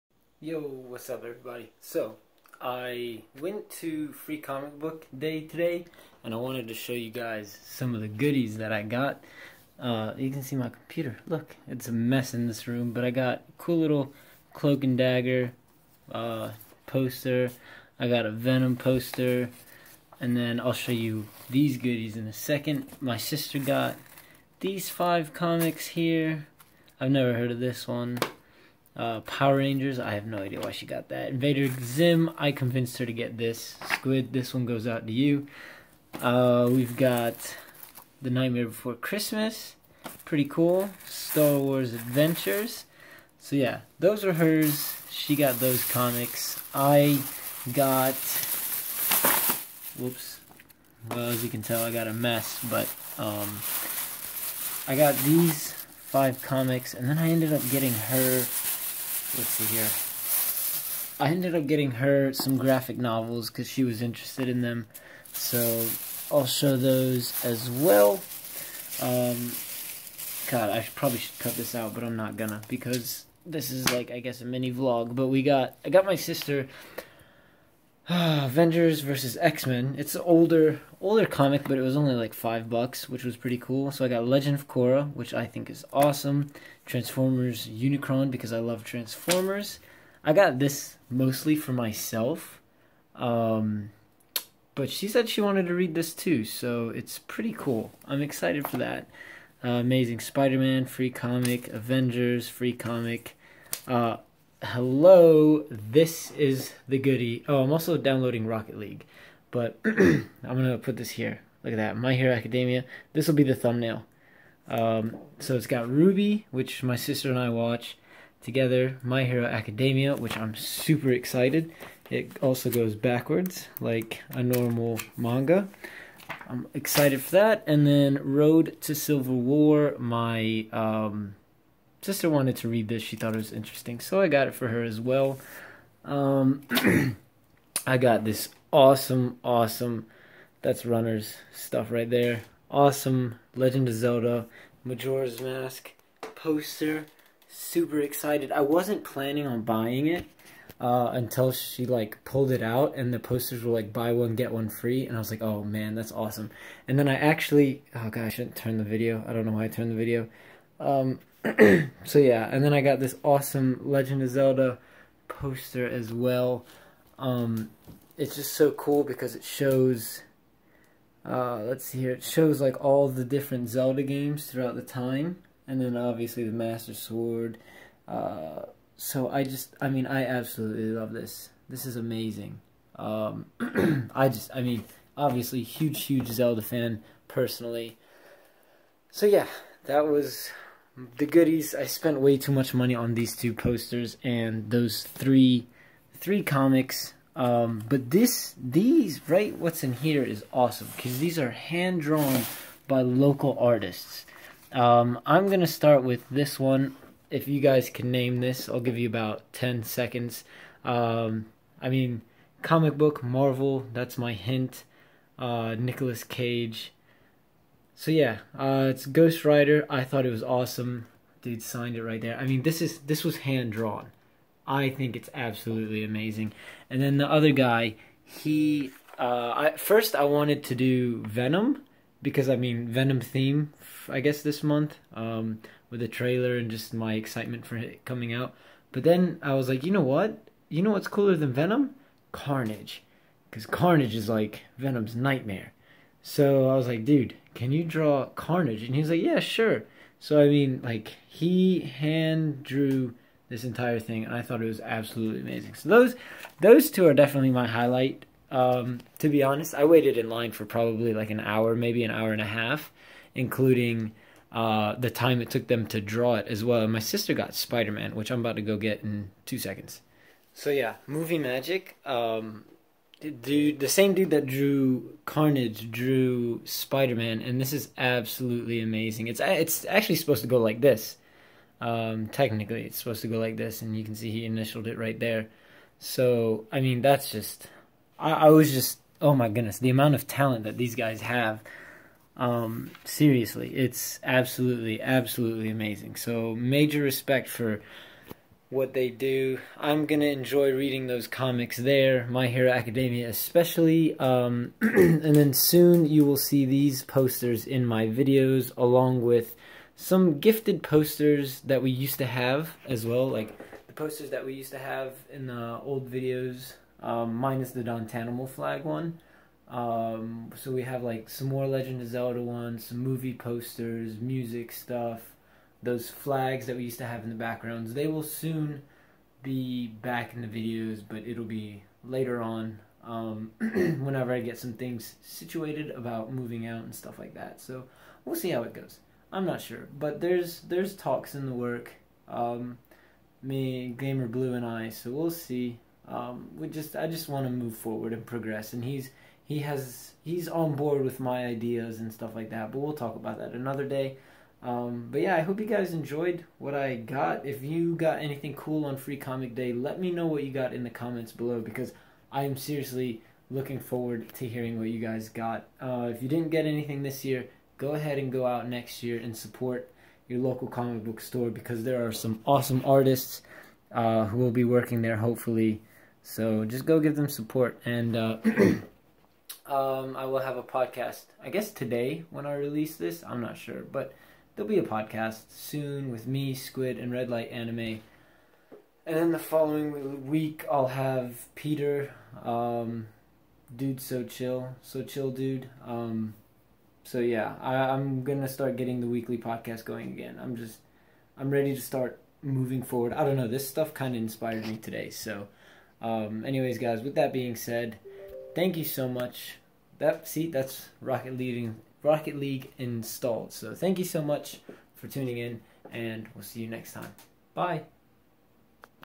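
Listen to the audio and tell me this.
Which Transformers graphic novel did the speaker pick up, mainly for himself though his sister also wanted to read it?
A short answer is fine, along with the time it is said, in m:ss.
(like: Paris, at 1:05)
Unicron, at 1:26.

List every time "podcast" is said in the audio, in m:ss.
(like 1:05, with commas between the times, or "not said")
6:20, 6:24, 6:39.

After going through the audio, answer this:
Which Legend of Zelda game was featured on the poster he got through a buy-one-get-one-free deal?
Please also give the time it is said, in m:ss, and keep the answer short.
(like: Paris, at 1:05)
Majora's Mask, at 2:24.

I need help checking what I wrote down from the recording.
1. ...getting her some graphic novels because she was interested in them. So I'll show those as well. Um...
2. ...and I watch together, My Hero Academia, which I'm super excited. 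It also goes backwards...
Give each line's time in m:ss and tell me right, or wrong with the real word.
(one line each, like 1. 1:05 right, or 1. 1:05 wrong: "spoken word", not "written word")
1. 1:01 right
2. 1:57 right.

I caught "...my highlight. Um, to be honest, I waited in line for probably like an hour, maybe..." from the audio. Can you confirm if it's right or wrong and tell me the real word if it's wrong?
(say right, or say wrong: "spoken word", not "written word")
right.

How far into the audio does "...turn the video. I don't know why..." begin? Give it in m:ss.
2:38.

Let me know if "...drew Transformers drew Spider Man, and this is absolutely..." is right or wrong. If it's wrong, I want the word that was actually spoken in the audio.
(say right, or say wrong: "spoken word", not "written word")
wrong: "Carnage", not "Transformers".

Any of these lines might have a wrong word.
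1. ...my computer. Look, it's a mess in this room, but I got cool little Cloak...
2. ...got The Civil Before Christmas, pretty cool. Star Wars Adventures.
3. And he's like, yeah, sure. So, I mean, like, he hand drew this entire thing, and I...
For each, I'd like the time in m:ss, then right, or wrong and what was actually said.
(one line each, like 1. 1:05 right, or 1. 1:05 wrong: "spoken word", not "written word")
1. 0:10 right
2. 0:36 wrong: "Nightmare", not "Civil"
3. 4:08 right.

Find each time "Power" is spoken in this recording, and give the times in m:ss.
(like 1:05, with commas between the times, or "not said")
0:29.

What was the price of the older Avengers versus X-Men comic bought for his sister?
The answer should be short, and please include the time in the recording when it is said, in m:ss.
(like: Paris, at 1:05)
5 bucks, at 1:22.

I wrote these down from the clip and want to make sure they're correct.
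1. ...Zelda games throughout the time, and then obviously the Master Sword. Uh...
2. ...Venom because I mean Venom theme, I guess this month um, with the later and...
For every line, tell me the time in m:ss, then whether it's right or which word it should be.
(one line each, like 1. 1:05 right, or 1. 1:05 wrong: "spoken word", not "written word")
1. 2:53 right
2. 3:51 wrong: "trailer", not "later".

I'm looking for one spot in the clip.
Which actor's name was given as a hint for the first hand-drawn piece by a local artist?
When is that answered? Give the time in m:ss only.
3:35.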